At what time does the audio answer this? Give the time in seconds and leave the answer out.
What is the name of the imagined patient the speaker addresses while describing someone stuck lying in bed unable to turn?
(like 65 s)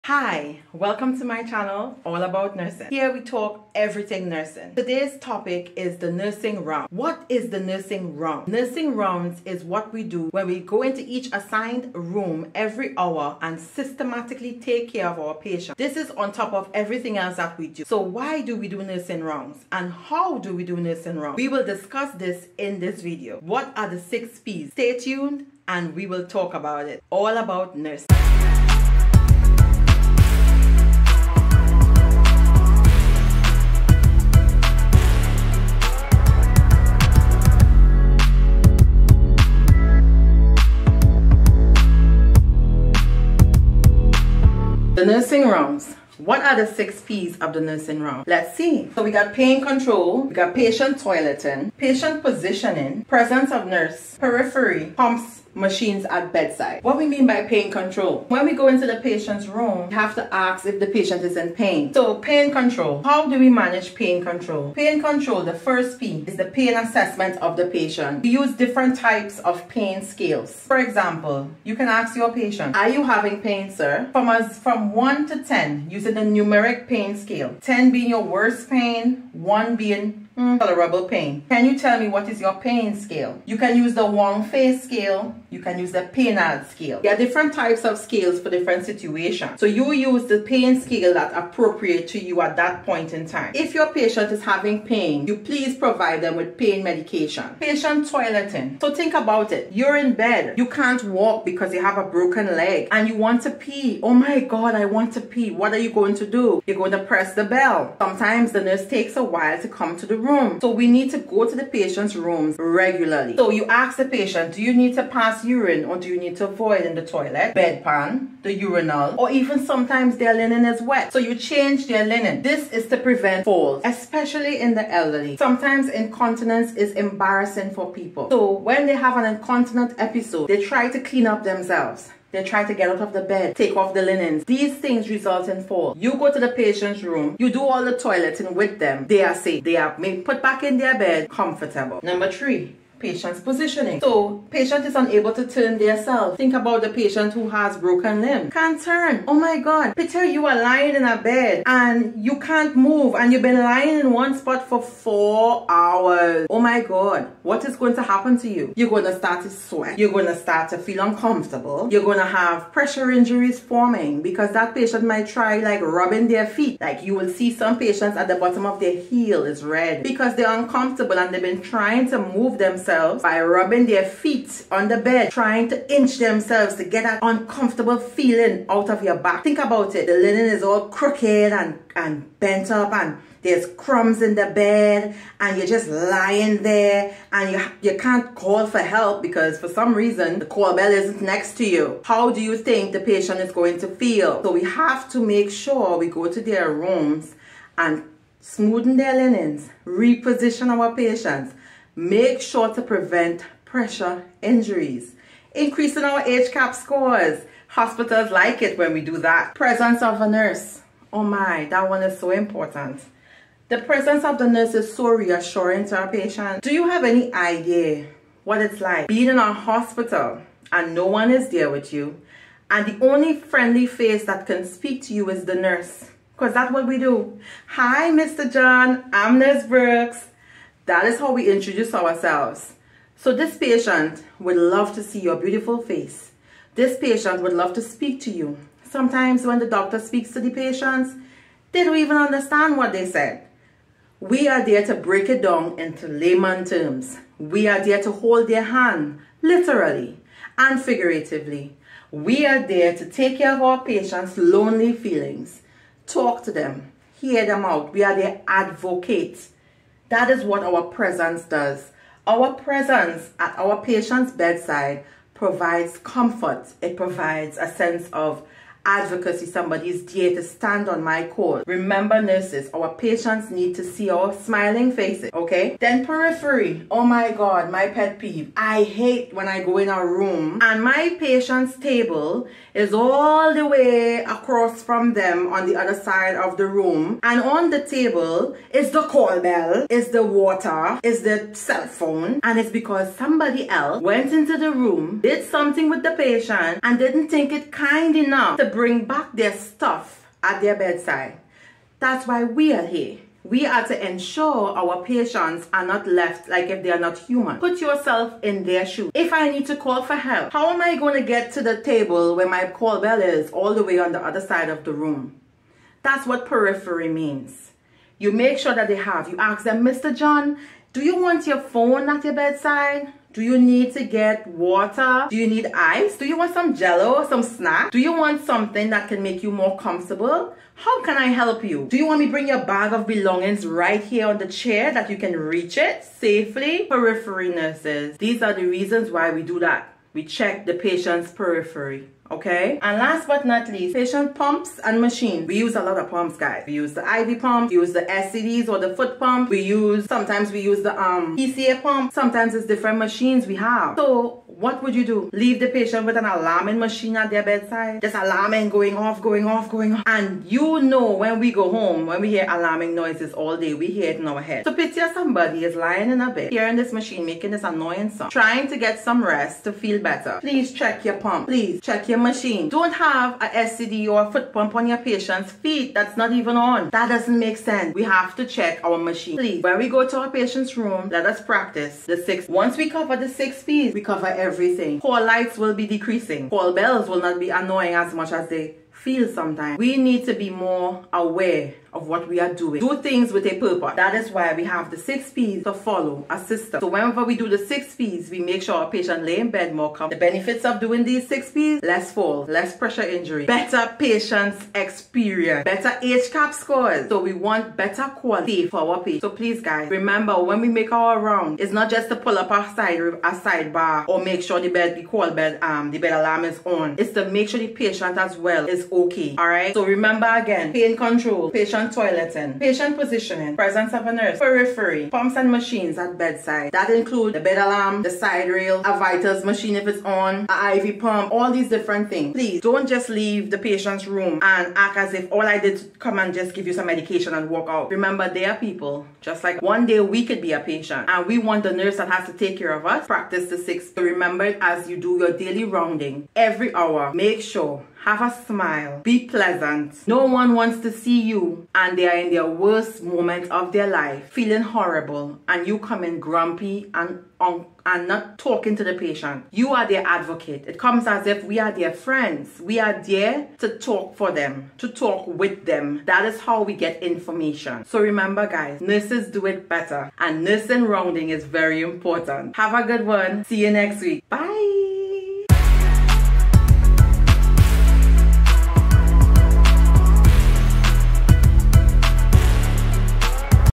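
149 s.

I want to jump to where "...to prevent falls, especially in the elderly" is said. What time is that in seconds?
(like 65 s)
122 s.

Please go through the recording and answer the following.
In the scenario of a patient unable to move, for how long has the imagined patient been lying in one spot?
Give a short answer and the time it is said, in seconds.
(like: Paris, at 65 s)
4 hours, at 154 s.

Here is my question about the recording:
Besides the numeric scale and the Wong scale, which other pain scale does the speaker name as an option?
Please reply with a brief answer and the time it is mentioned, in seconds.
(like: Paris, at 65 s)
PAINAD scale, at 86 s.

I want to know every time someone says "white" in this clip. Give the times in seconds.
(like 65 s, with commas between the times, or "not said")
not said.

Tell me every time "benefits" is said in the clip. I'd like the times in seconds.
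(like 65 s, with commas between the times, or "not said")
400 s.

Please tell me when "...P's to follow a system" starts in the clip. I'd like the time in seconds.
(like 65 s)
395 s.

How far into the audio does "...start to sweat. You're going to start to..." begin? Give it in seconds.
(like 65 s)
159 s.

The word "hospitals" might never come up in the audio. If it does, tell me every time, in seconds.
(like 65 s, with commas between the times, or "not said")
207 s, 219 s.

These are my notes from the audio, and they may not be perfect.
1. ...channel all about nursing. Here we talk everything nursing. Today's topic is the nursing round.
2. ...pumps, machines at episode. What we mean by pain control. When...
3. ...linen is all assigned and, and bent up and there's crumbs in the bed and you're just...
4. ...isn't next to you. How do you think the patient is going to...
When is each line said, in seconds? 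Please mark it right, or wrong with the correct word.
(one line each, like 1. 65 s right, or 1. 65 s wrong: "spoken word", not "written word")
1. 1 s right
2. 54 s wrong: "bedside", not "episode"
3. 180 s wrong: "crooked", not "assigned"
4. 190 s right.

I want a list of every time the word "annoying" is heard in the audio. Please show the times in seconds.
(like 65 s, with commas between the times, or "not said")
367 s, 387 s.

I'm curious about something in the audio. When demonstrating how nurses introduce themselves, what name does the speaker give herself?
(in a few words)
Nurse Brooks.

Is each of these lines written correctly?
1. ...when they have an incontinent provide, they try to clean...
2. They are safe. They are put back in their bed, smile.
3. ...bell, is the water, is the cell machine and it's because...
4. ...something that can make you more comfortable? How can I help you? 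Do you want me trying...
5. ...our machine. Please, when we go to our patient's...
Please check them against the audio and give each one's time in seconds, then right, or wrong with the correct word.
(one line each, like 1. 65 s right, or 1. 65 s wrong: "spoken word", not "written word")
1. 128 s wrong: "episode", not "provide"
2. 139 s wrong: "comfortable", not "smile"
3. 289 s wrong: "phone", not "machine"
4. 328 s wrong: "bring", not "trying"
5. 378 s right.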